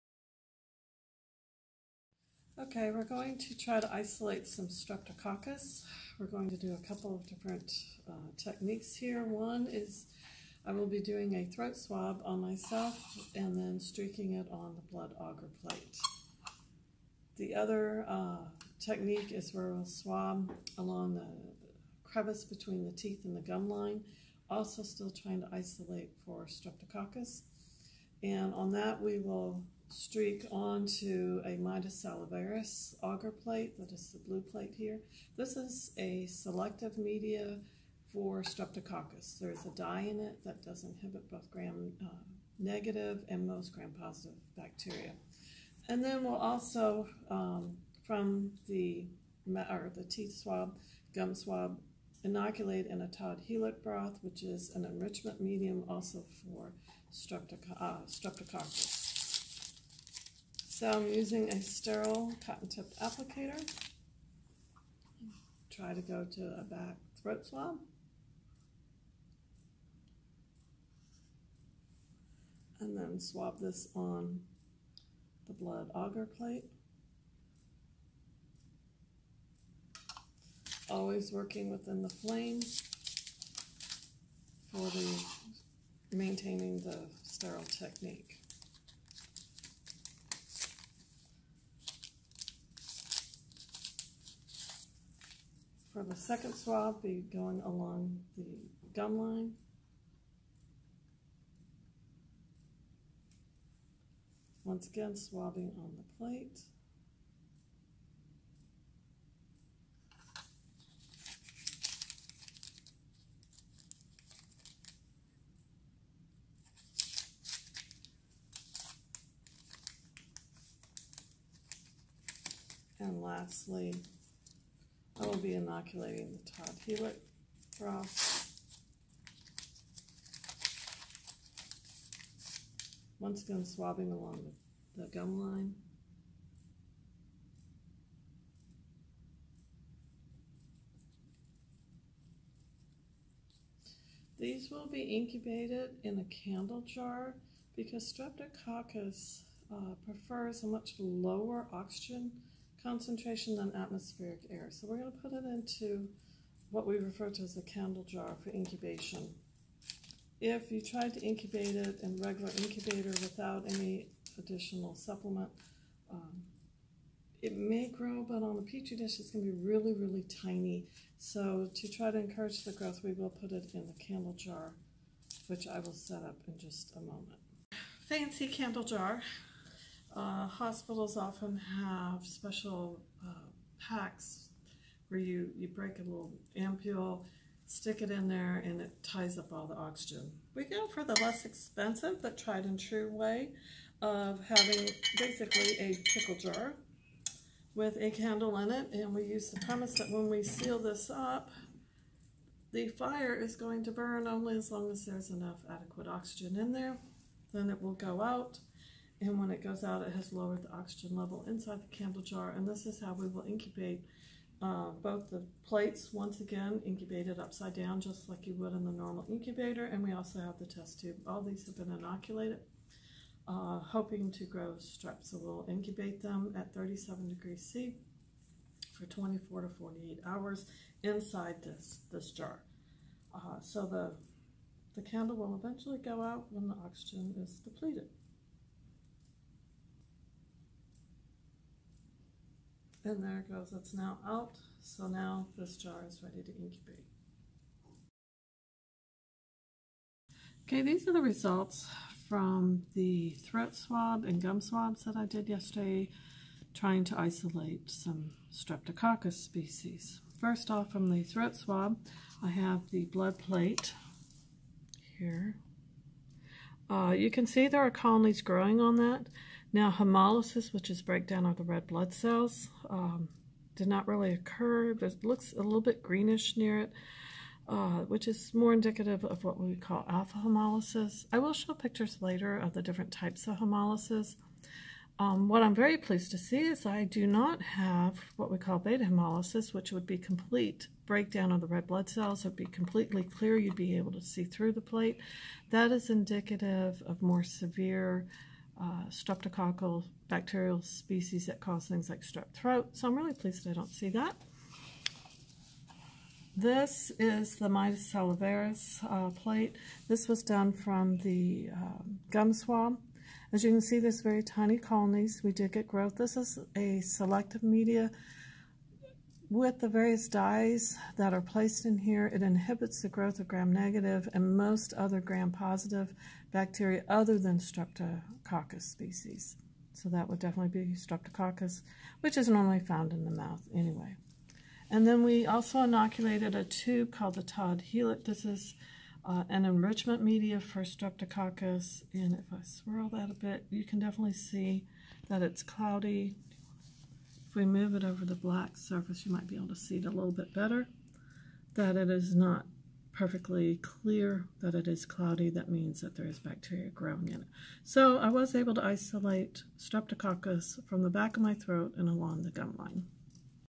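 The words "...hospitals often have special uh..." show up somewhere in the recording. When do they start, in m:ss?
3:00.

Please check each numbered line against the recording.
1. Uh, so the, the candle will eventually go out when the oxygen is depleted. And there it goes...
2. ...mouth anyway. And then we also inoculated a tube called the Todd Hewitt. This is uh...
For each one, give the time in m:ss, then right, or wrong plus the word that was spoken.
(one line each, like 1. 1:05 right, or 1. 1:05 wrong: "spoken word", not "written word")
1. 3:53 right
2. 5:33 right.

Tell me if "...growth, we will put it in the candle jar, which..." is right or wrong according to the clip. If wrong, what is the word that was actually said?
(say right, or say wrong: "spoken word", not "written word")
right.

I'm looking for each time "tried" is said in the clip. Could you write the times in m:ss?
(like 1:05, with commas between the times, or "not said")
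2:40, 3:12.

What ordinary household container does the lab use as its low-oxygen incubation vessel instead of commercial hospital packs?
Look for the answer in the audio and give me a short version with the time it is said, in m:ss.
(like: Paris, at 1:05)
Pickle jar, at 3:16.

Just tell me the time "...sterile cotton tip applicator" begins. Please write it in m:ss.
1:01.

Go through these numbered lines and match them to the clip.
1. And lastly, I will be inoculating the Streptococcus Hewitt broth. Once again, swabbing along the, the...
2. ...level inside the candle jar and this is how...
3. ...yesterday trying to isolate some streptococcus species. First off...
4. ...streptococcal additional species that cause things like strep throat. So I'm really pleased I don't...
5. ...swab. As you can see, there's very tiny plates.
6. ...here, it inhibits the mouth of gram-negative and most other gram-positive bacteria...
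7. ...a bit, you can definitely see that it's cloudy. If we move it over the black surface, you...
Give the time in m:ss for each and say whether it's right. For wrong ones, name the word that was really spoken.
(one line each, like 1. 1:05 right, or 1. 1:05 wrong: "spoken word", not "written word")
1. 2:02 wrong: "Todd", not "Streptococcus"
2. 3:31 right
3. 4:15 right
4. 4:59 wrong: "bacterial", not "additional"
5. 5:12 wrong: "colonies", not "plates"
6. 5:21 wrong: "growth", not "mouth"
7. 5:43 right.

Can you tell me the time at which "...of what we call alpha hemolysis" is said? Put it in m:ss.
4:39.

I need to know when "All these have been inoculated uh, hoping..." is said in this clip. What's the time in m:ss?
3:41.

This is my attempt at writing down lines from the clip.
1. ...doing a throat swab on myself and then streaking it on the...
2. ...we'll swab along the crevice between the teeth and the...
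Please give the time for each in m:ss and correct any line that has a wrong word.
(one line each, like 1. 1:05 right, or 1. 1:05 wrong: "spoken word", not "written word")
1. 0:11 right
2. 0:19 right.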